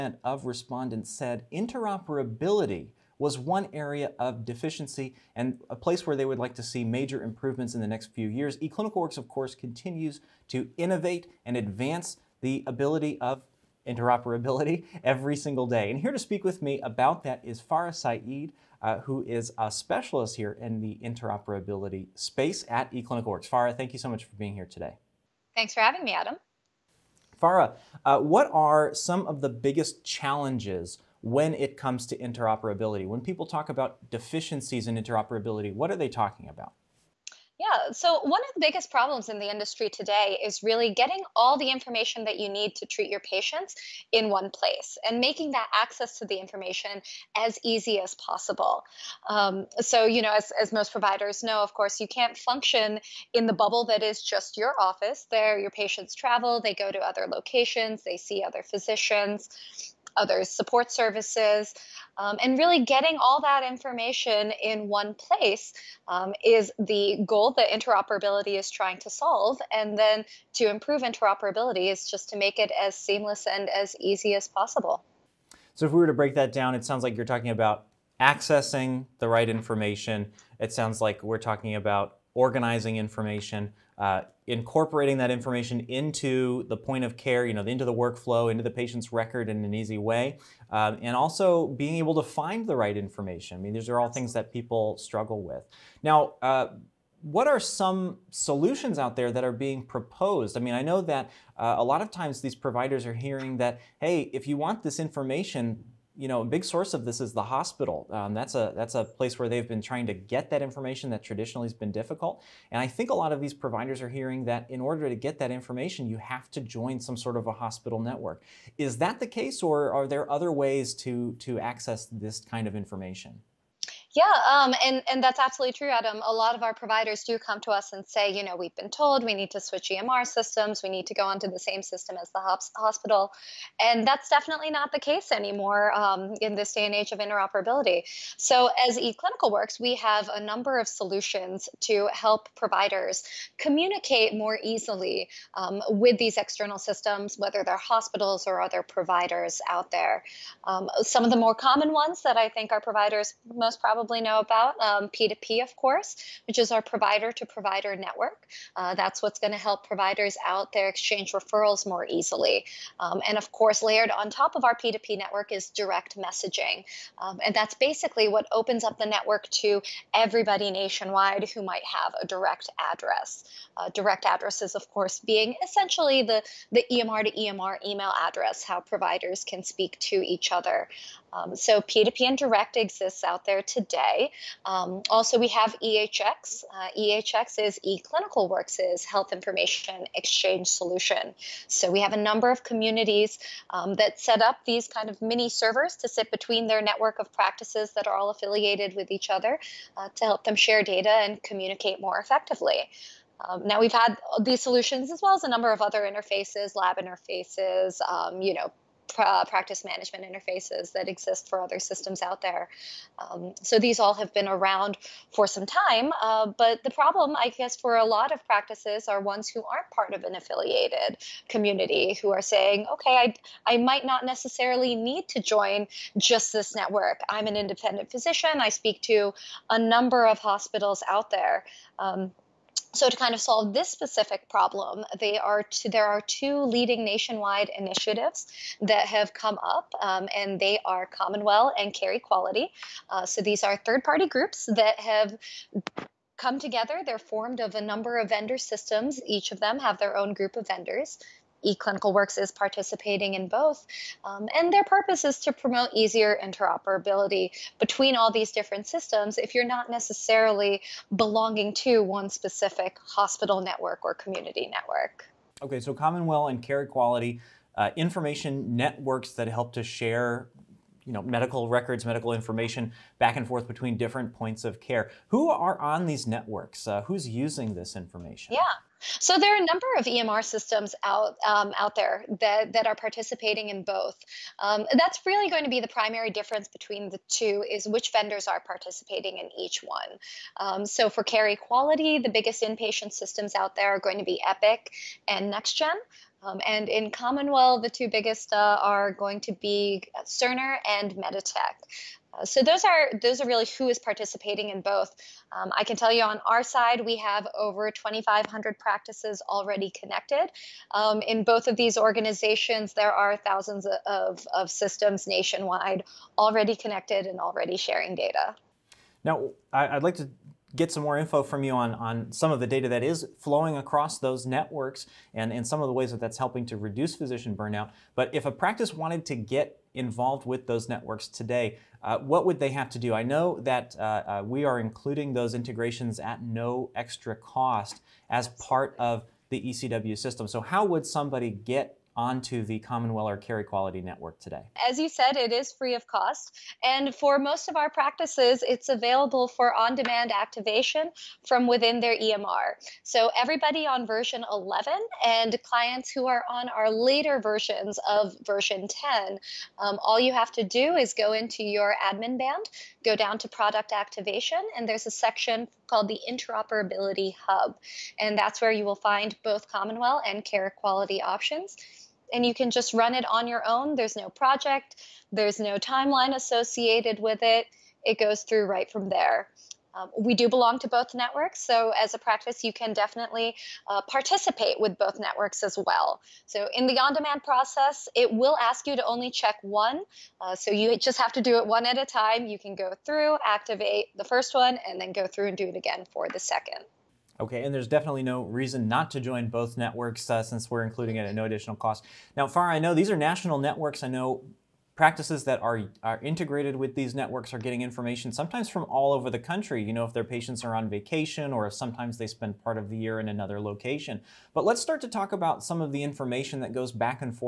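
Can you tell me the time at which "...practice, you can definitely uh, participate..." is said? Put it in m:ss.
6:22.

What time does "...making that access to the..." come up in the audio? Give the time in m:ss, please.
0:45.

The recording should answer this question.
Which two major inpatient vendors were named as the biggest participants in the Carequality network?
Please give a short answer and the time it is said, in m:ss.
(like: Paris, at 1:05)
Epic and NextGen, at 4:54.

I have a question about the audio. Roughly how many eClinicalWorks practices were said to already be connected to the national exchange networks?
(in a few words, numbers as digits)
over 2,500.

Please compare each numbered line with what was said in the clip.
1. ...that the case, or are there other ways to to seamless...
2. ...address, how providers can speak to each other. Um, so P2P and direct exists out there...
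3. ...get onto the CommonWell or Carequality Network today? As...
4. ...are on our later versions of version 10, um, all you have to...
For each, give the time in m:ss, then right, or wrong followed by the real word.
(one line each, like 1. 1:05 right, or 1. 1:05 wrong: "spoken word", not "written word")
1. 1:58 wrong: "access", not "seamless"
2. 2:58 right
3. 5:41 right
4. 5:56 right.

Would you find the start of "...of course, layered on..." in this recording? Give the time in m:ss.
2:43.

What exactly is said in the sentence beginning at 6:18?
It goes through right from there.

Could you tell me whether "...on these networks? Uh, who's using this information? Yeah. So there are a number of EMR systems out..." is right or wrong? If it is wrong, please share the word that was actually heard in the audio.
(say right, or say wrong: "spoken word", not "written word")
right.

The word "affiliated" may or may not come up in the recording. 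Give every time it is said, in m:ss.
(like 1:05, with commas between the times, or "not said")
3:18, 3:40.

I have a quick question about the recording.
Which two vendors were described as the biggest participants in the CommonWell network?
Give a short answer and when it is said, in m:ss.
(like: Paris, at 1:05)
Cerner and Meditech, at 5:00.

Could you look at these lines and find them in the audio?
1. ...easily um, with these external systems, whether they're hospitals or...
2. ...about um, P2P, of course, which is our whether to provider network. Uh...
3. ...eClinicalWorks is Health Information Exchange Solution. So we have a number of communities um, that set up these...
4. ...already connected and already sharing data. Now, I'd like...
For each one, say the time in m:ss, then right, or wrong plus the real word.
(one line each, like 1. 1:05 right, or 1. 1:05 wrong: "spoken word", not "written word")
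1. 2:24 right
2. 2:34 wrong: "provider", not "whether"
3. 3:07 right
4. 5:16 right.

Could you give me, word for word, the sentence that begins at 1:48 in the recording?
Um, that's a that's a place where they've been trying to get that information that traditionally has been difficult.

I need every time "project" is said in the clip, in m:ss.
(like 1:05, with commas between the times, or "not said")
6:14.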